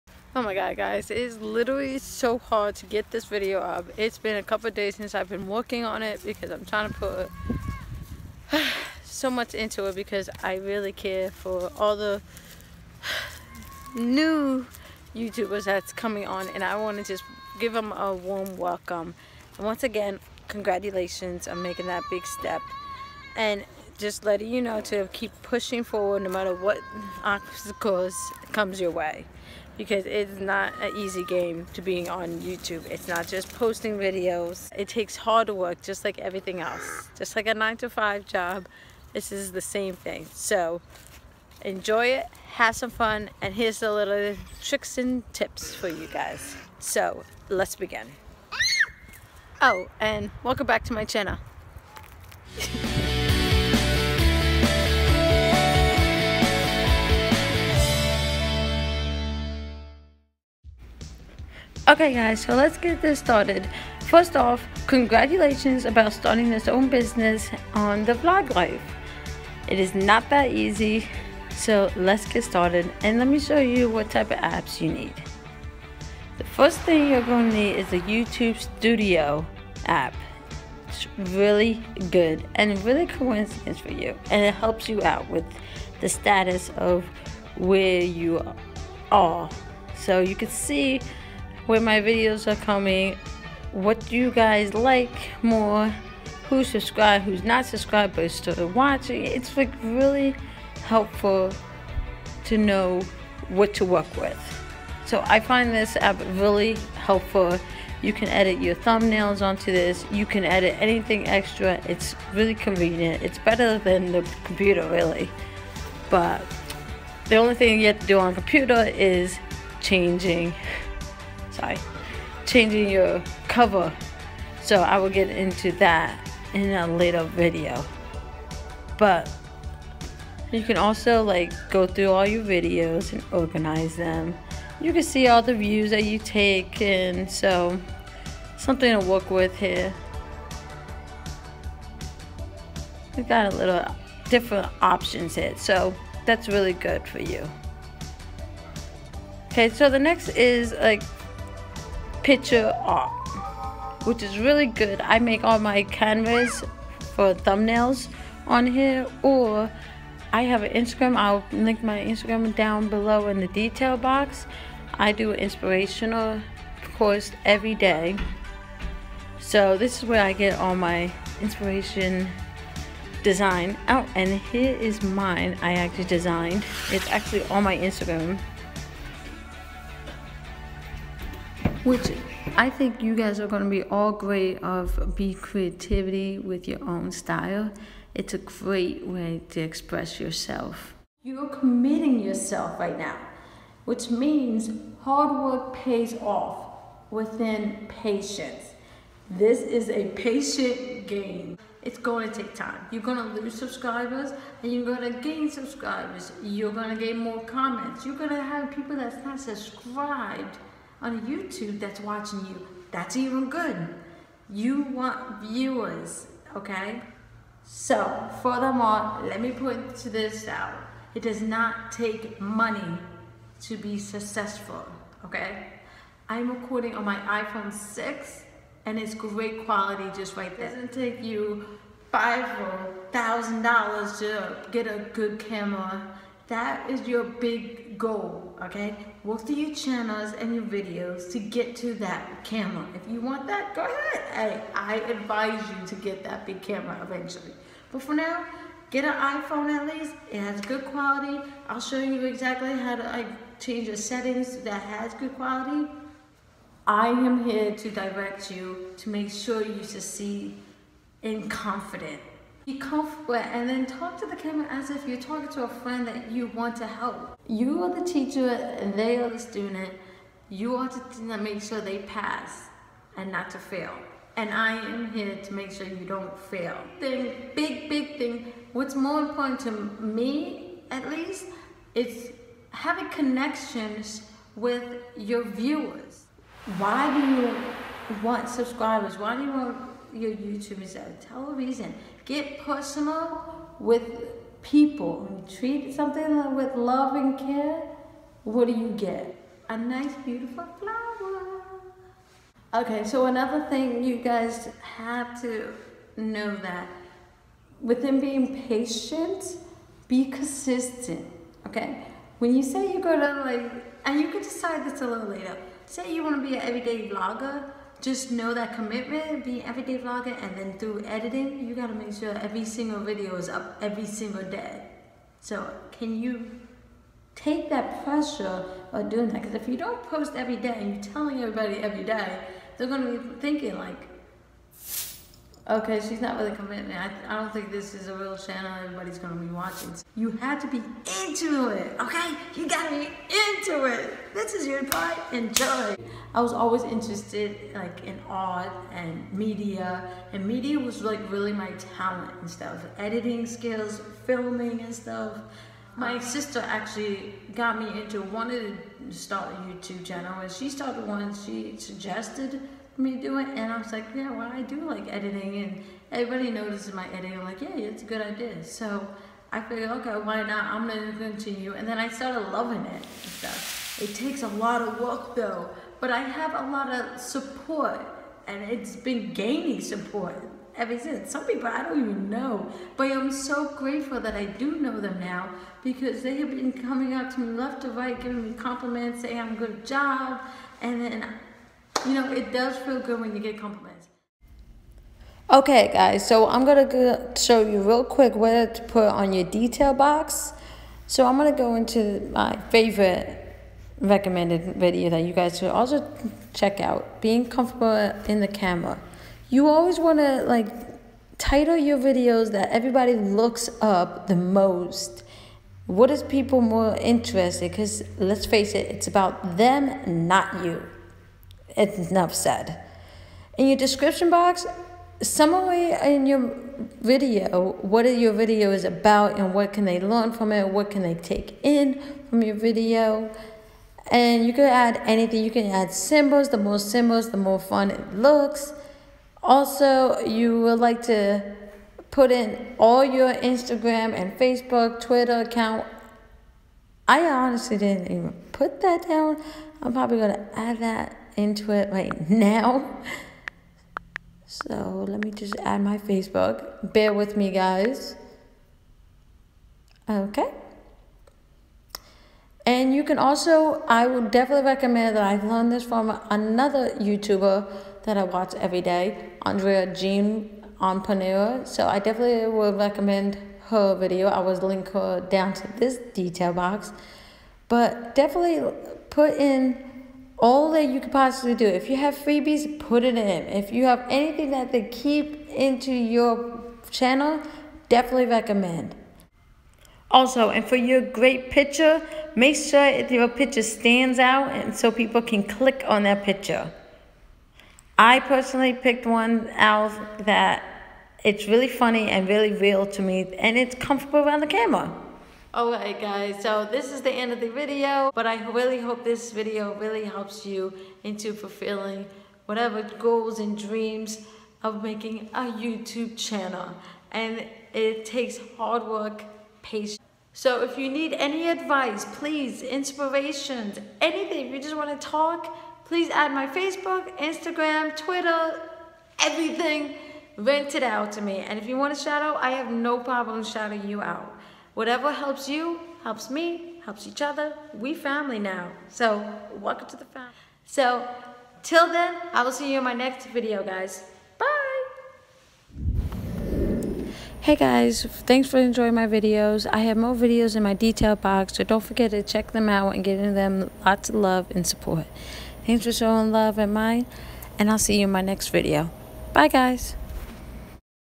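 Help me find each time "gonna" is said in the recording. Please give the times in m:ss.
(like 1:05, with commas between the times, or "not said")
5:32, 5:39, 6:36, 6:41.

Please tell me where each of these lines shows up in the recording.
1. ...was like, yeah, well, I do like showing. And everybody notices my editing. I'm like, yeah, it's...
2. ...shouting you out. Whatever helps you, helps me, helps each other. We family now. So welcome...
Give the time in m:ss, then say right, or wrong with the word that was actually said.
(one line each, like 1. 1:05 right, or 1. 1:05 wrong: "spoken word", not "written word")
1. 6:03 wrong: "editing", not "showing"
2. 8:53 right.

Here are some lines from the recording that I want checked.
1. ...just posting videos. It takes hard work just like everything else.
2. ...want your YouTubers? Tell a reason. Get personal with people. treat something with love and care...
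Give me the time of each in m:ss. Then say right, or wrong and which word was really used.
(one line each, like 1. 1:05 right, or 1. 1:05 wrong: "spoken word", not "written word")
1. 0:33 right
2. 4:49 right.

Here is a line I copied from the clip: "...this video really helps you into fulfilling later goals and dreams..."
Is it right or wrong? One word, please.
wrong.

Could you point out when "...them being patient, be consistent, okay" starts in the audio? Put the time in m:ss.
5:08.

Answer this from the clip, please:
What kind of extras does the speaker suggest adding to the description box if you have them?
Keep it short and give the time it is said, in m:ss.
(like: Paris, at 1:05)
Freebies, at 8:02.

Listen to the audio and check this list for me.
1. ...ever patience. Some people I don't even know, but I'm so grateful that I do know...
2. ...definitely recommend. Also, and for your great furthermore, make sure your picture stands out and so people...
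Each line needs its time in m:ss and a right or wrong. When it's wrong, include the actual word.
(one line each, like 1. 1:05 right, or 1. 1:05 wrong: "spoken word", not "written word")
1. 6:20 wrong: "since", not "patience"
2. 8:07 wrong: "picture", not "furthermore".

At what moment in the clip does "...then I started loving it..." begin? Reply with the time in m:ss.
6:11.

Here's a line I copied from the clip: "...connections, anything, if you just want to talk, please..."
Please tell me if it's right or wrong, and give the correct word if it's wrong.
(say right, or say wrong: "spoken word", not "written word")
wrong: "inspirations", not "connections".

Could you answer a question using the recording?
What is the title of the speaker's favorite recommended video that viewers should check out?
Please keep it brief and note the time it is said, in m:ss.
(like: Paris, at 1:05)
Being comfortable in the camera, at 6:47.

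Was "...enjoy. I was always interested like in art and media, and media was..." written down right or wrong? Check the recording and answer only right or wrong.
right.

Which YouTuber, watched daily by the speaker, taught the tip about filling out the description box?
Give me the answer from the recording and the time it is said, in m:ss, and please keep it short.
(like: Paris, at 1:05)
Andrea Jean Entrepreneur, at 7:49.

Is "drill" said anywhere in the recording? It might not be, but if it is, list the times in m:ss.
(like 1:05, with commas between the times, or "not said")
not said.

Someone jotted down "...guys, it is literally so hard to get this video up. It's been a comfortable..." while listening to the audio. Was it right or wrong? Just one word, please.
wrong.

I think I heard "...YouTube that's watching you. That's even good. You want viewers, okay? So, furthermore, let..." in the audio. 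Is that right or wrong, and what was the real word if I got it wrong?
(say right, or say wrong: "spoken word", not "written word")
right.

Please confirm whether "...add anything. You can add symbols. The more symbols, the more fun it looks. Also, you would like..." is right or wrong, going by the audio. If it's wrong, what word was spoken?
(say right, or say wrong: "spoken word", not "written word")
right.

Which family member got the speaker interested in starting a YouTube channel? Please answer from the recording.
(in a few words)
Sister.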